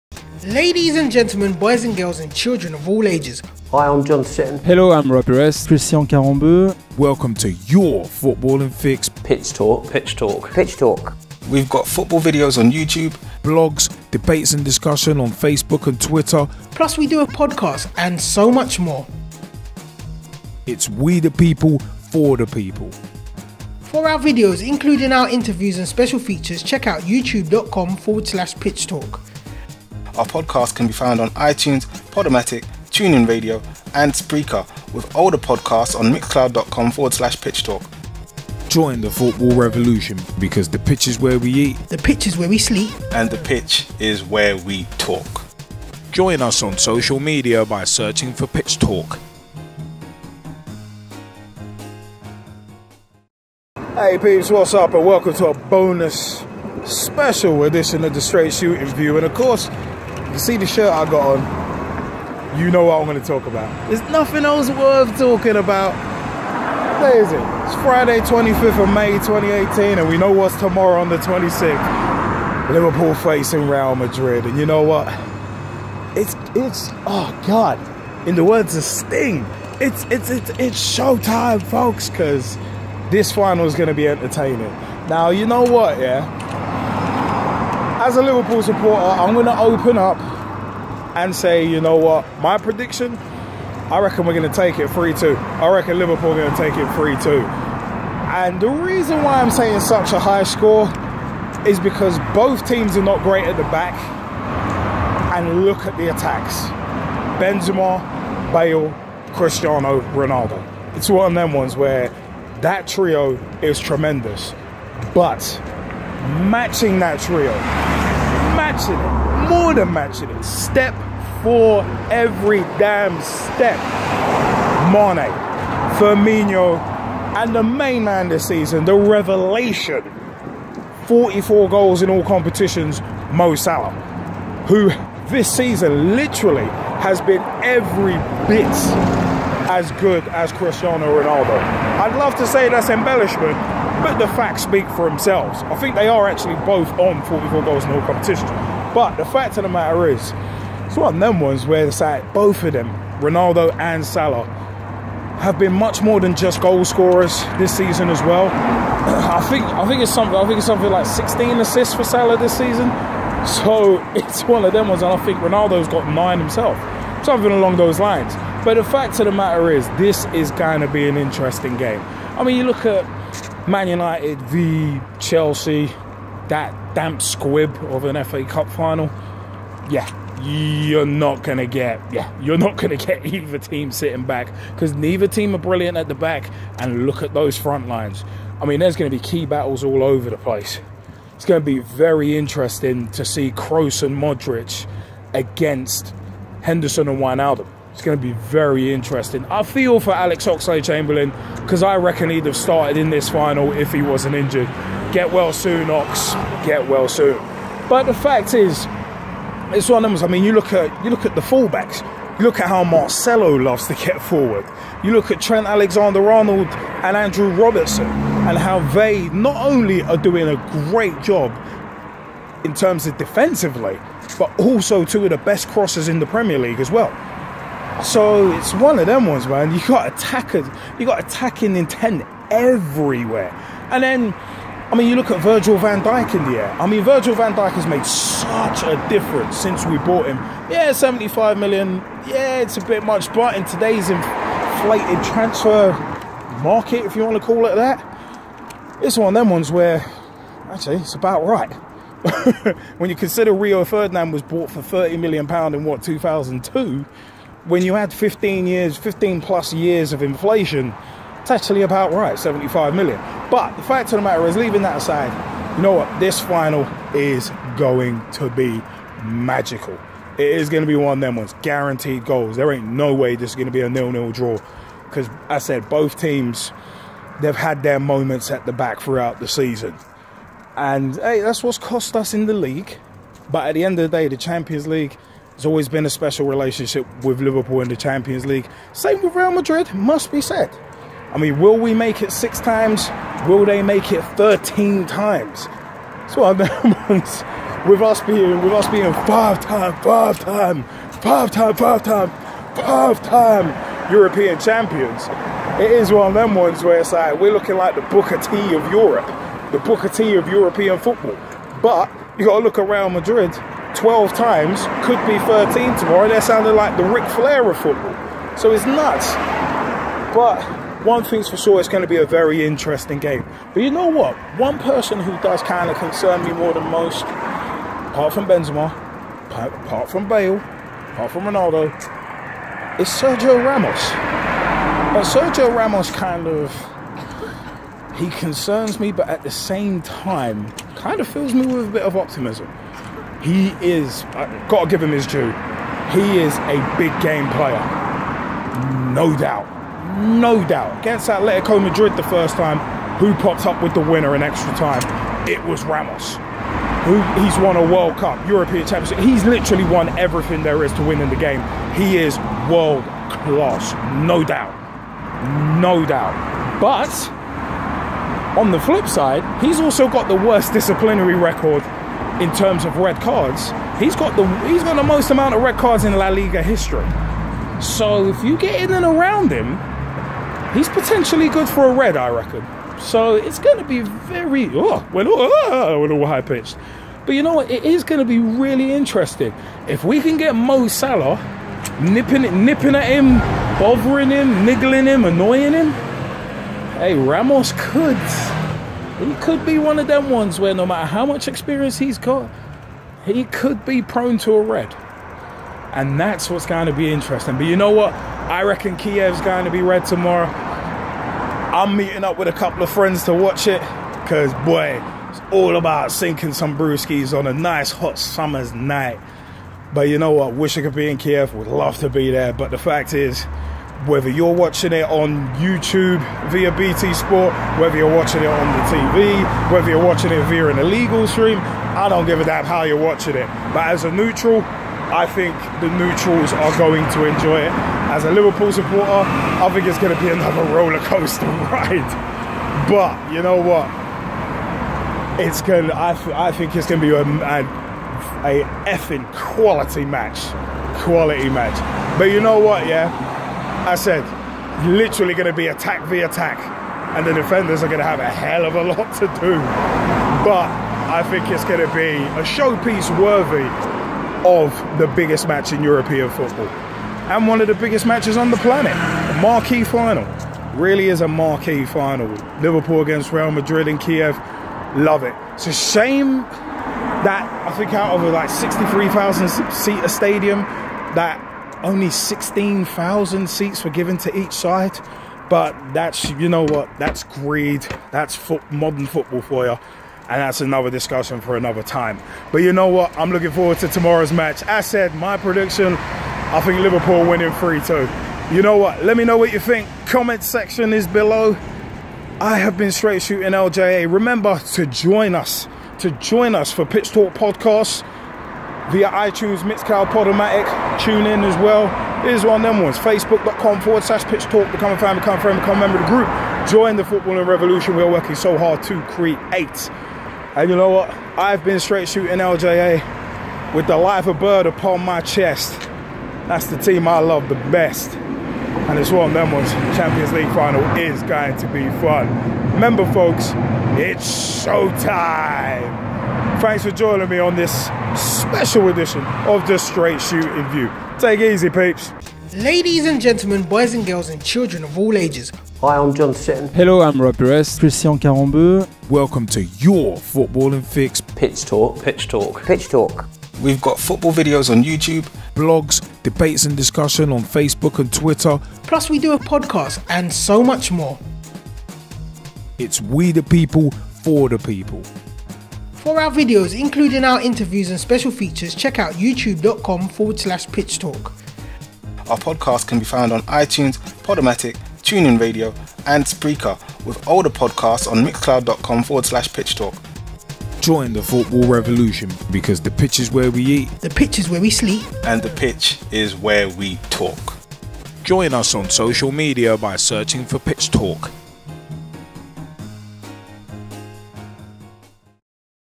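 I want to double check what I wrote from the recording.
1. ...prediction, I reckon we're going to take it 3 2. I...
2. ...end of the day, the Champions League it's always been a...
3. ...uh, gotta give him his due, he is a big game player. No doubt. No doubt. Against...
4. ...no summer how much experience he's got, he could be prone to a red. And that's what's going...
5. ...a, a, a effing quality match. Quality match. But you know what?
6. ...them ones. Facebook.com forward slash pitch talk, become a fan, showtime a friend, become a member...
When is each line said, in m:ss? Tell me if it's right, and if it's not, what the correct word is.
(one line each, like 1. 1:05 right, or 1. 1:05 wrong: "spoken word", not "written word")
1. 1:32 right
2. 4:43 right
3. 5:44 right
4. 6:40 wrong: "matter", not "summer"
5. 7:27 right
6. 8:32 wrong: "become", not "showtime".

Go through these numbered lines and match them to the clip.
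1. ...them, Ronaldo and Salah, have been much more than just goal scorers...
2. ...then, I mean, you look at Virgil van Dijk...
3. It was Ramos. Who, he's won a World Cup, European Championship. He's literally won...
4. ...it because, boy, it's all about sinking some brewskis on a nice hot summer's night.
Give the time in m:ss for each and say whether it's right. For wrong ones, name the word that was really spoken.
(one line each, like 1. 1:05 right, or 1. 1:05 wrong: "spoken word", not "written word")
1. 2:32 right
2. 3:54 right
3. 5:55 right
4. 6:53 right.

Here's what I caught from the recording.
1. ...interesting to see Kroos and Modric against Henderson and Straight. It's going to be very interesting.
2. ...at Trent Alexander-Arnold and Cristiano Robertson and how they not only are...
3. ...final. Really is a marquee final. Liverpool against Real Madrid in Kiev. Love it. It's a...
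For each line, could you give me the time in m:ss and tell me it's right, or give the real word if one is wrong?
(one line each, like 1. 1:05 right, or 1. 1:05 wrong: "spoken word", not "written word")
1. 3:12 wrong: "Wijnaldum", not "Straight"
2. 3:35 wrong: "Andrew", not "Cristiano"
3. 7:49 right.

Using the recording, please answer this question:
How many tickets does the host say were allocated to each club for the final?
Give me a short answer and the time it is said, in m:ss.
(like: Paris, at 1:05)
16,000, at 8:02.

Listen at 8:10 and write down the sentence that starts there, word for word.
And that's another discussion for another time.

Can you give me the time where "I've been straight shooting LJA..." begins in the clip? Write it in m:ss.
8:41.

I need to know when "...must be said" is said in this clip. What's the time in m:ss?
4:49.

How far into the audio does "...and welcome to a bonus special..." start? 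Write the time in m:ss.
0:54.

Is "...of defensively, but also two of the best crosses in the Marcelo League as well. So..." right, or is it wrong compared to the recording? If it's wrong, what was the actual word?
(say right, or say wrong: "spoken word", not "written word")
wrong: "Premier", not "Marcelo".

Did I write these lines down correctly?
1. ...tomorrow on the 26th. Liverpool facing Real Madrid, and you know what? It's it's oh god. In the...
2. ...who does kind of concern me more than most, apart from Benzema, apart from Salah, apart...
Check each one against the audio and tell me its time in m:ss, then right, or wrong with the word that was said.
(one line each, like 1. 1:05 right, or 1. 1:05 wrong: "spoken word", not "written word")
1. 1:10 right
2. 5:25 wrong: "Bale", not "Salah".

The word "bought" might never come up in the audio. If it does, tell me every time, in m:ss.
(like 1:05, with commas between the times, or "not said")
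3:59, 4:14.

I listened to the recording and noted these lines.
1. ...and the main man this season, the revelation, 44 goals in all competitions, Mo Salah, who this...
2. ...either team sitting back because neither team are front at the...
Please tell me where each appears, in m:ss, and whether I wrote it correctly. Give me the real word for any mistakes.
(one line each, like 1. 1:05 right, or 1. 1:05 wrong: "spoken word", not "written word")
1. 2:07 right
2. 3:03 wrong: "brilliant", not "front".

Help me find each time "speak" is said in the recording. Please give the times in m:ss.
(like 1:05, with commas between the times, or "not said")
2:24.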